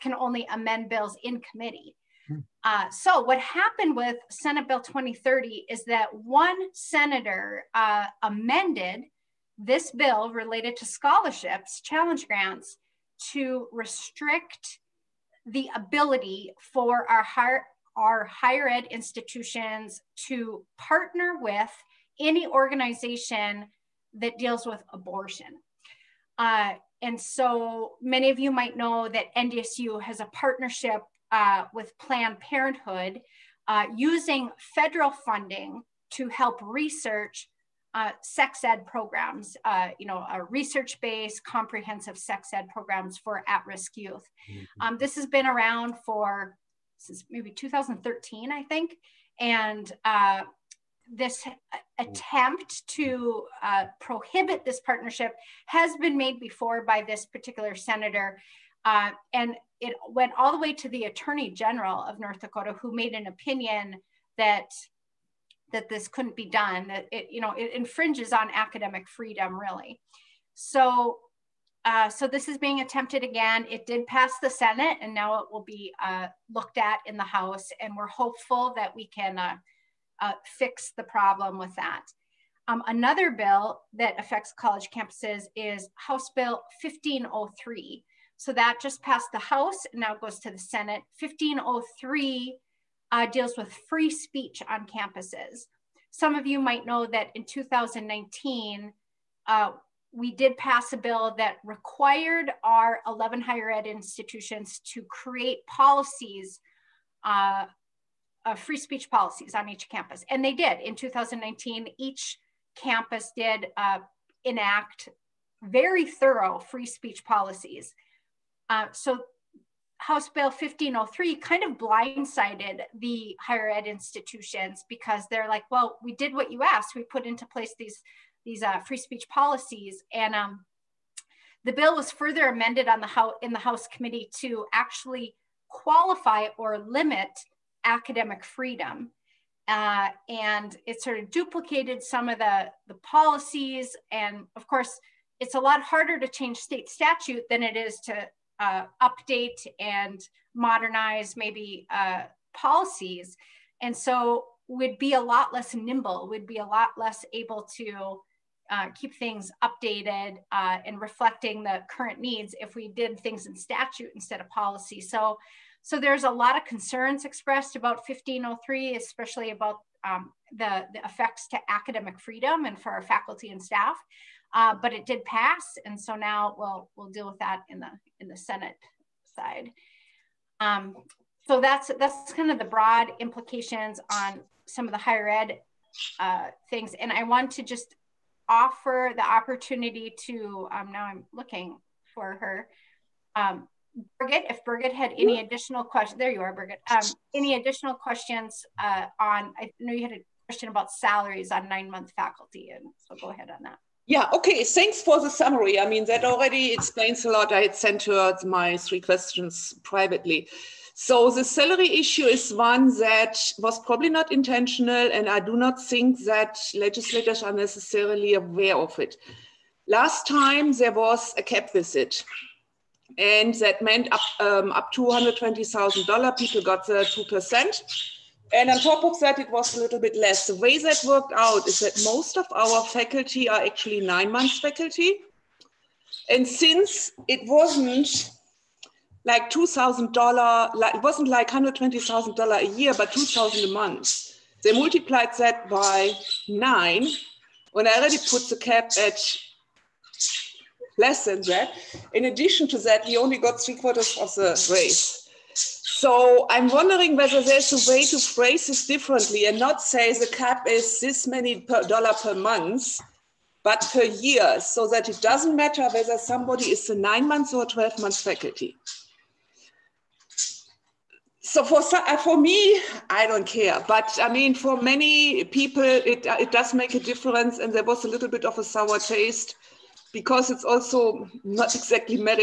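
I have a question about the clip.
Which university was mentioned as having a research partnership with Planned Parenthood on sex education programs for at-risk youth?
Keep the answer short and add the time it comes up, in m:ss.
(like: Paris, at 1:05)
NDSU, at 0:29.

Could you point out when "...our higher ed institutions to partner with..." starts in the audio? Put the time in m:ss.
0:17.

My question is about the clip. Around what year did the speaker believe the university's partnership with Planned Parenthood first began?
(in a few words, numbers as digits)
2013.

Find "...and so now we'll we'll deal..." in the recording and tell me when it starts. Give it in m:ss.
2:55.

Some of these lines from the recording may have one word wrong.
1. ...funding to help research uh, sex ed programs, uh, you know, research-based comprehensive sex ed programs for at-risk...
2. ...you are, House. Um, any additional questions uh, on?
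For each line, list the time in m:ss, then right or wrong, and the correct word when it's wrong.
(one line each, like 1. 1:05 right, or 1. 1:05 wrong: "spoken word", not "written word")
1. 0:35 right
2. 3:16 wrong: "Birgit", not "House".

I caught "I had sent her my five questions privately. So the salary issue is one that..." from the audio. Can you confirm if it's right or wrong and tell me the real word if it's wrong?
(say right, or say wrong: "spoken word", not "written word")
wrong: "three", not "five".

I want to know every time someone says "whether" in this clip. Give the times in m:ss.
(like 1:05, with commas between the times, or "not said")
4:17, 4:25.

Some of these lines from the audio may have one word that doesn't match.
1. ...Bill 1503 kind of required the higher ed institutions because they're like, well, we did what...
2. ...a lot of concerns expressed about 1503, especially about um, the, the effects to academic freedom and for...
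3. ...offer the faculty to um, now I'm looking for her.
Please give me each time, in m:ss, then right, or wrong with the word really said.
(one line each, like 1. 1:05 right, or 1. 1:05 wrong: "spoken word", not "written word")
1. 2:00 wrong: "blindsided", not "required"
2. 2:46 right
3. 3:08 wrong: "opportunity", not "faculty".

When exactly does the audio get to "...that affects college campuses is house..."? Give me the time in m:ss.
1:23.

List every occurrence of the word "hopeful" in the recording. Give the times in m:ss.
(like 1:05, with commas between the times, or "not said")
1:18.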